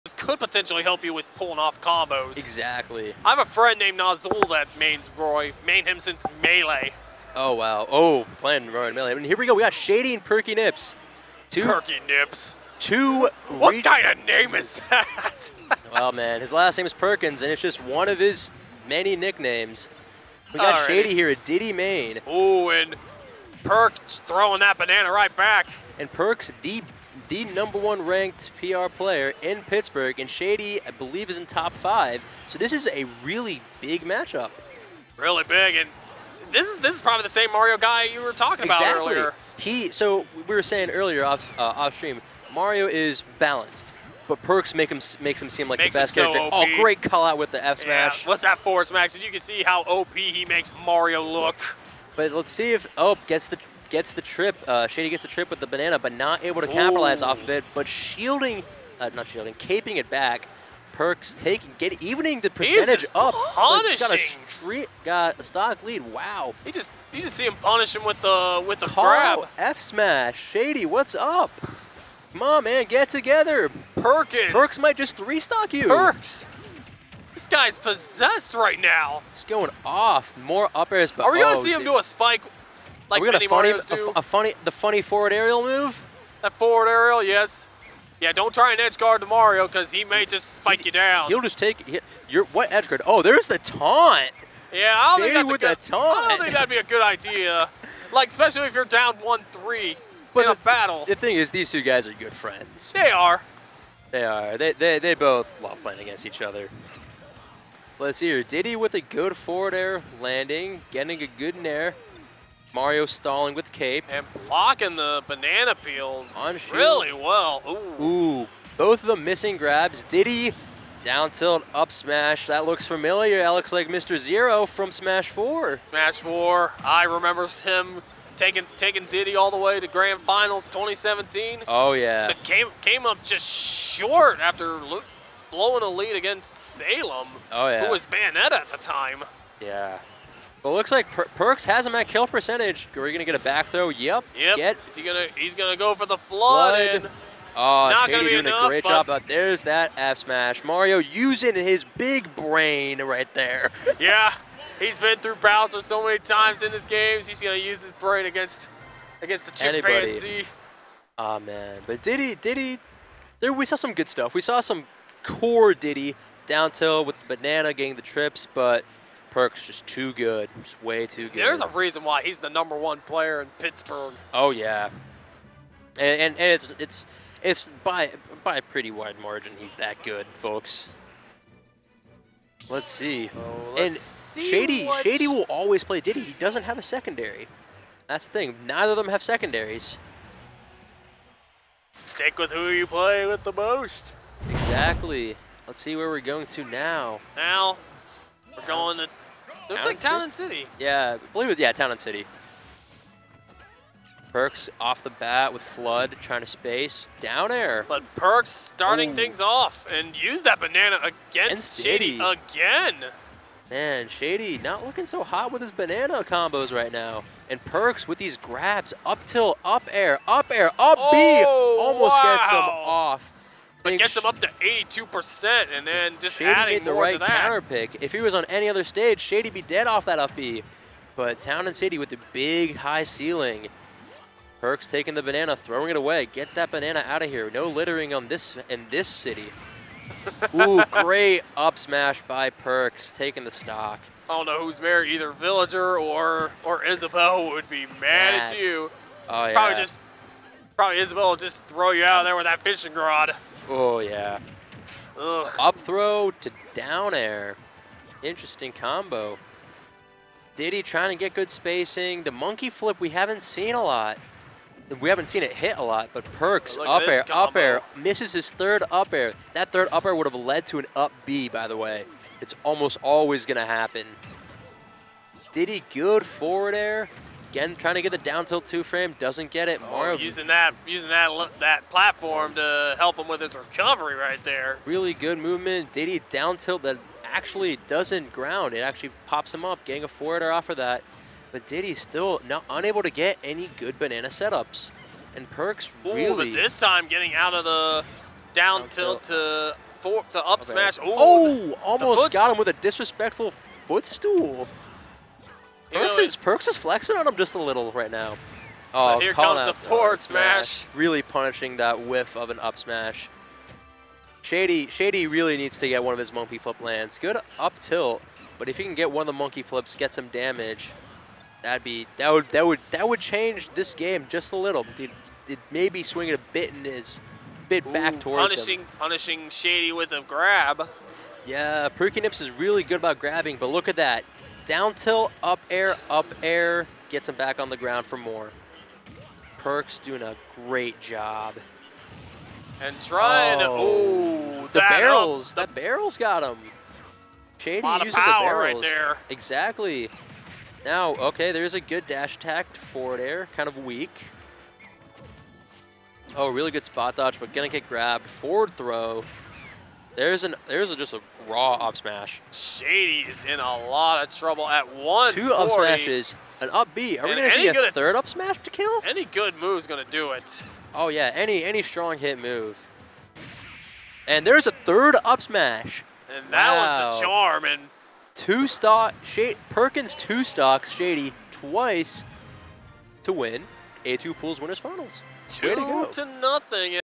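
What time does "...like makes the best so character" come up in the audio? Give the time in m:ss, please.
0:45.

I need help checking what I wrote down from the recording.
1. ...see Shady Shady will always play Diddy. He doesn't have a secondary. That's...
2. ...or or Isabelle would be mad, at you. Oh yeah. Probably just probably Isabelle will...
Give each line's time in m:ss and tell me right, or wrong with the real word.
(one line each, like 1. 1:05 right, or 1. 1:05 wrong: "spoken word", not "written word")
1. 3:04 right
2. 4:05 right.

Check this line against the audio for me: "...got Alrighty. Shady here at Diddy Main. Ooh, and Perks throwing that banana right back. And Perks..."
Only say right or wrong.
right.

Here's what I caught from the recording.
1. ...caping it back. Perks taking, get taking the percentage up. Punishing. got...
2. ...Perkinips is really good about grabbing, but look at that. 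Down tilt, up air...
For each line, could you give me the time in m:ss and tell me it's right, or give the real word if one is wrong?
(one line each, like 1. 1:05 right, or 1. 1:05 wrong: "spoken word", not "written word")
1. 0:59 wrong: "evening", not "taking"
2. 5:31 right.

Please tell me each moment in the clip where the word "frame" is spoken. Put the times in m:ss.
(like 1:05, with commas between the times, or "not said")
4:38.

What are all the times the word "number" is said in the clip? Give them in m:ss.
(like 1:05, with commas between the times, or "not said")
0:27, 2:52.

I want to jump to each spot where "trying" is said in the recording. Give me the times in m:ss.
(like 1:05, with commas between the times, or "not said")
3:26, 4:20, 4:37, 5:43.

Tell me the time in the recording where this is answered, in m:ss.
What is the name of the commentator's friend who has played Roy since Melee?
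0:03.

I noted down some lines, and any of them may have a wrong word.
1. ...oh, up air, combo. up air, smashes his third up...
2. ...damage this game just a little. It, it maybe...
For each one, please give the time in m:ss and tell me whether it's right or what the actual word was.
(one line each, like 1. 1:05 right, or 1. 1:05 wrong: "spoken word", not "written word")
1. 4:26 wrong: "misses", not "smashes"
2. 5:23 wrong: "change", not "damage".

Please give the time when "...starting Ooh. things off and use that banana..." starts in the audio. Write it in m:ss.
3:28.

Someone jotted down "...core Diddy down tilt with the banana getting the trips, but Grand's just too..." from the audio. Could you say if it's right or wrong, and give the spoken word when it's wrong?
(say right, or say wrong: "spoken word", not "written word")
wrong: "Perk", not "Grand".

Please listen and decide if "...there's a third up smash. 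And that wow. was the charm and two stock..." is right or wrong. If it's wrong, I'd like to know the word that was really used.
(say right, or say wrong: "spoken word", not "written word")
right.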